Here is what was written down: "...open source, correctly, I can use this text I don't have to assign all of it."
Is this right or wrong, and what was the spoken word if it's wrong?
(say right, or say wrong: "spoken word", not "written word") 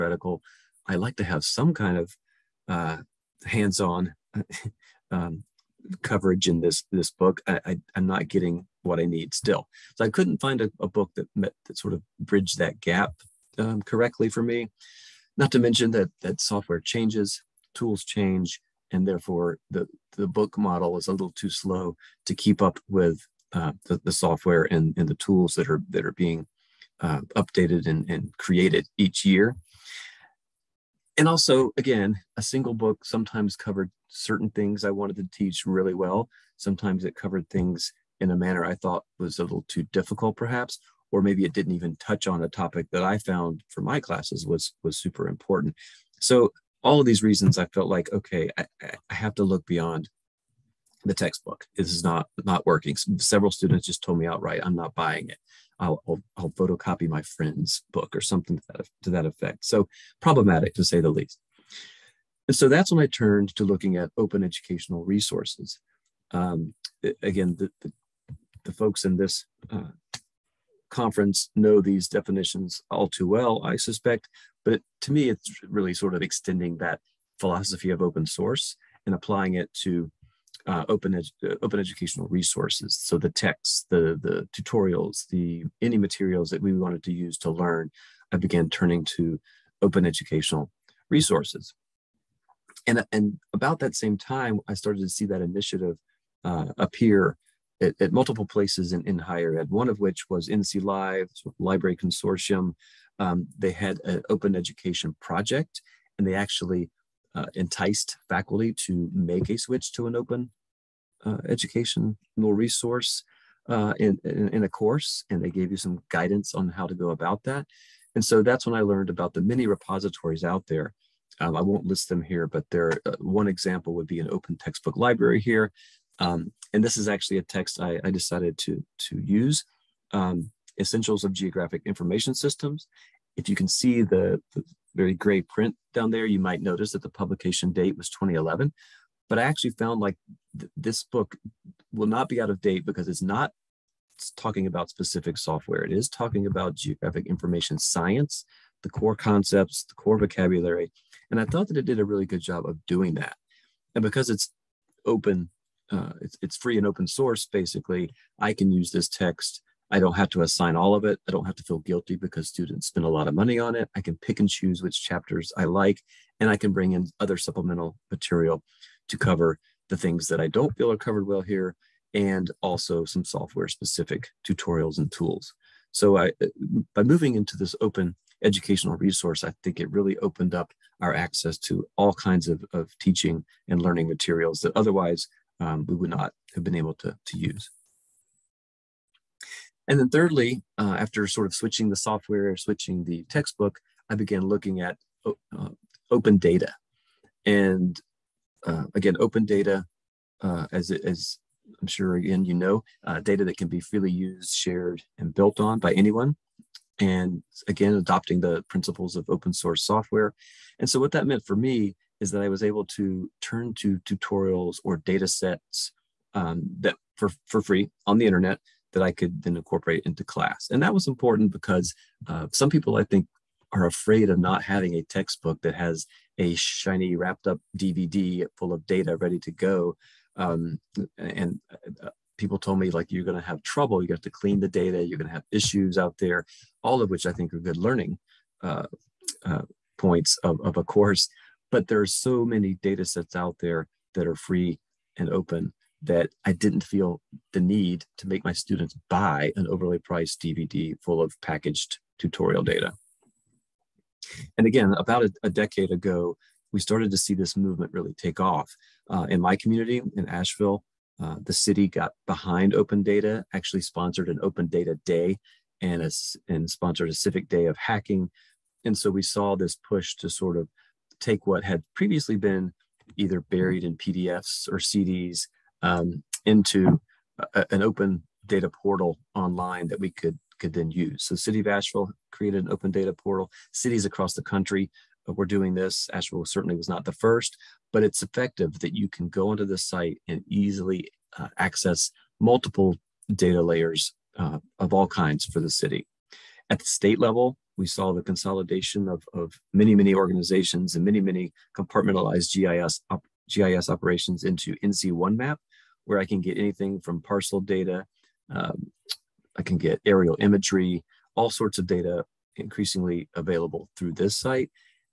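wrong: "basically", not "correctly".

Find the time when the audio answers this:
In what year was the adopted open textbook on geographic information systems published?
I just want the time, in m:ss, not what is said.
2:18.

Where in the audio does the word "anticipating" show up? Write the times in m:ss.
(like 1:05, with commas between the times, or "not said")
not said.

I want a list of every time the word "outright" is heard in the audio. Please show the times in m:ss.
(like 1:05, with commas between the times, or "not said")
0:54.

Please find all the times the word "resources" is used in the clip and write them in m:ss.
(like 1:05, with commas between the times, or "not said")
1:05, 1:22, 1:31, 1:52, 2:58.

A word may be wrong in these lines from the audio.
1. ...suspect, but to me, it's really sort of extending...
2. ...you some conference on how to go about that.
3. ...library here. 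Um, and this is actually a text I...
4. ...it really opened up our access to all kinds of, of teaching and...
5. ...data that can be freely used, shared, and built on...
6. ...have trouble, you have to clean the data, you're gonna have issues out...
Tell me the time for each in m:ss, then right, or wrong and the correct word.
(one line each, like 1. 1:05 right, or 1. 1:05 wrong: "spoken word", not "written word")
1. 1:13 right
2. 1:55 wrong: "guidance", not "conference"
3. 2:04 right
4. 2:59 right
5. 3:23 right
6. 3:53 right.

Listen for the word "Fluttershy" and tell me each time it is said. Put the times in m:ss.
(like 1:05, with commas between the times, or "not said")
not said.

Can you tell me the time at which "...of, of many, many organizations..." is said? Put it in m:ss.
4:59.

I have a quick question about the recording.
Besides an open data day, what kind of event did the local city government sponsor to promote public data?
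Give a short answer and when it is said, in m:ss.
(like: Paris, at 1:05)
civic day of hacking, at 4:27.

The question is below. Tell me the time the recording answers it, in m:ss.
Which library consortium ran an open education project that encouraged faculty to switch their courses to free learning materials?
1:40.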